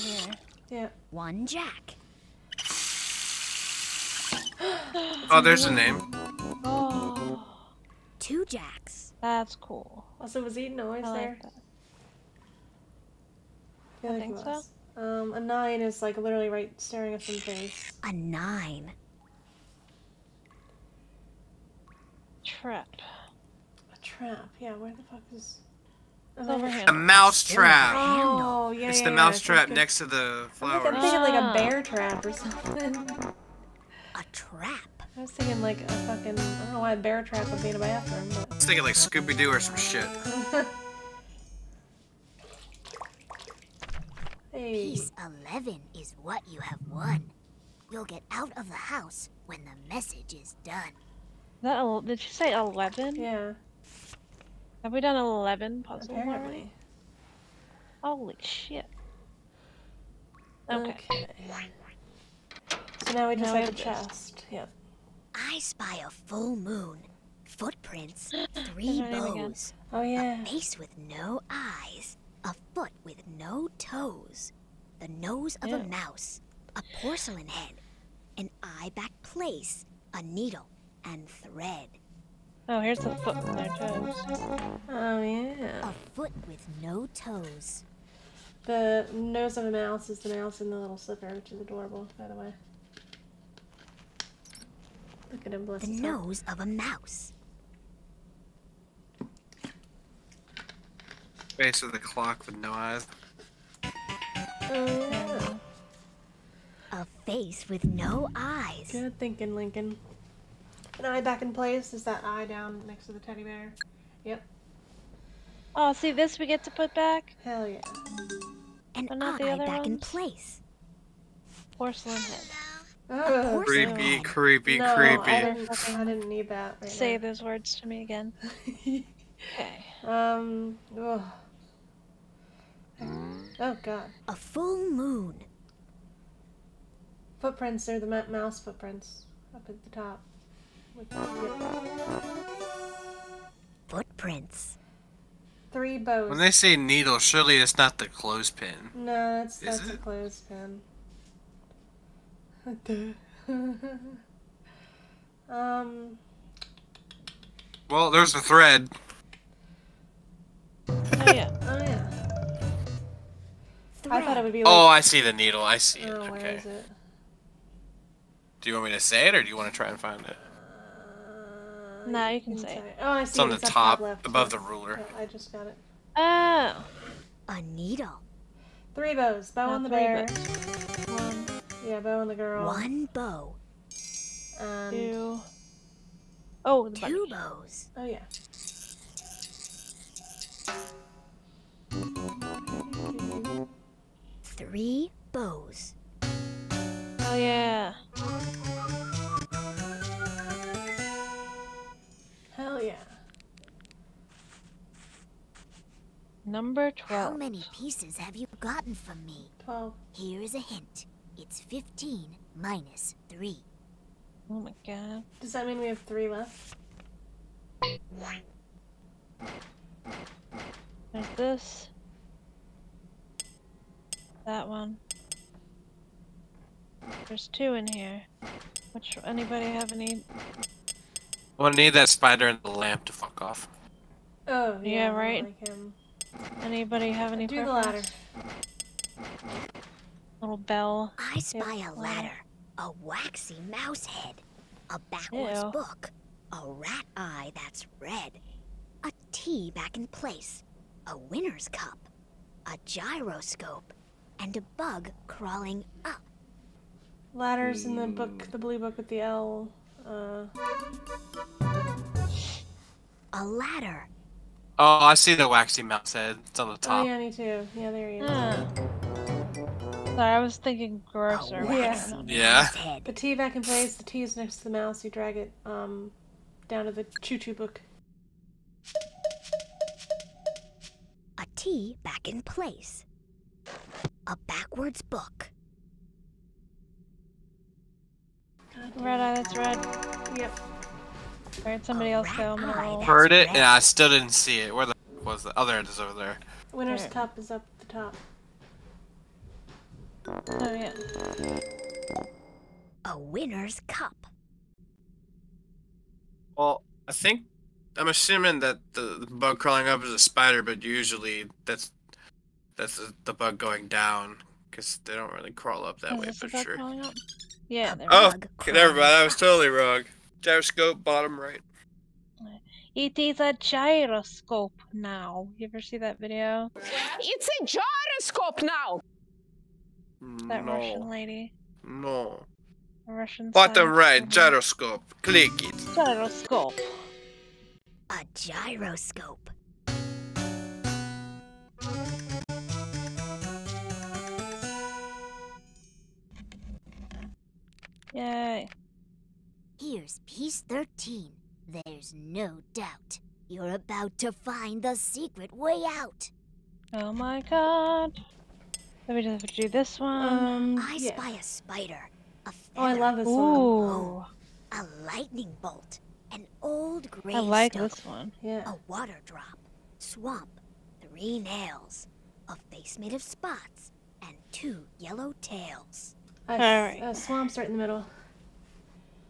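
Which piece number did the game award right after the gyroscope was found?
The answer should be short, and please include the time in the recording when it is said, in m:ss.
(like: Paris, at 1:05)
13, at 5:50.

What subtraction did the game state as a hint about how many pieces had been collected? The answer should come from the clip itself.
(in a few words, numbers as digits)
15 minus 3.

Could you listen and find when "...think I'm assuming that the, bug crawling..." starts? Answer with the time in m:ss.
5:07.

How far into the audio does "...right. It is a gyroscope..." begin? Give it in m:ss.
5:21.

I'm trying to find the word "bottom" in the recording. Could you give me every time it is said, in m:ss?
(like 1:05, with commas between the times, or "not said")
5:21, 5:33.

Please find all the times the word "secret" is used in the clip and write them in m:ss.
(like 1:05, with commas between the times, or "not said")
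5:54.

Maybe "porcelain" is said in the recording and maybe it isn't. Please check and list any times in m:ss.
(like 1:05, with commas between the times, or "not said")
1:16, 2:01.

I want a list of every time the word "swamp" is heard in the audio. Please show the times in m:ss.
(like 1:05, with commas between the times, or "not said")
6:09, 6:17.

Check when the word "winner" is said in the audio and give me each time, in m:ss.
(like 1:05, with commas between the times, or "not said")
4:11, 4:56, 5:03.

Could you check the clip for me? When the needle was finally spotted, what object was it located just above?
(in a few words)
The ruler.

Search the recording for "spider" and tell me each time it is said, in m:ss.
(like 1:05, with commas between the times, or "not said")
3:52, 5:10, 6:01.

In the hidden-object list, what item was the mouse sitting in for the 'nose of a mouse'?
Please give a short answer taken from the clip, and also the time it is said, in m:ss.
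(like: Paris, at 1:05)
Slipper, at 1:30.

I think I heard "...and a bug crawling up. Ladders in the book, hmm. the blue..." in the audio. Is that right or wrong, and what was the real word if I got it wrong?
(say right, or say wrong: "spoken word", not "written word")
right.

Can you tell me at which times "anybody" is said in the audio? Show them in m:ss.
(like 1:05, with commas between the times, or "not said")
3:49, 3:56.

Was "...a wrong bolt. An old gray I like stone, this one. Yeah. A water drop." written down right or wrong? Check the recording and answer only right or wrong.
wrong.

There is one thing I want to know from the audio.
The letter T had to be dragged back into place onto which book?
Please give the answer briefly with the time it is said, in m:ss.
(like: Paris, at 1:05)
The choo choo book, at 4:37.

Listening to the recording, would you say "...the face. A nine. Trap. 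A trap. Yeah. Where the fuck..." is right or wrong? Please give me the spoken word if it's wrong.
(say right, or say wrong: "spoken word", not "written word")
right.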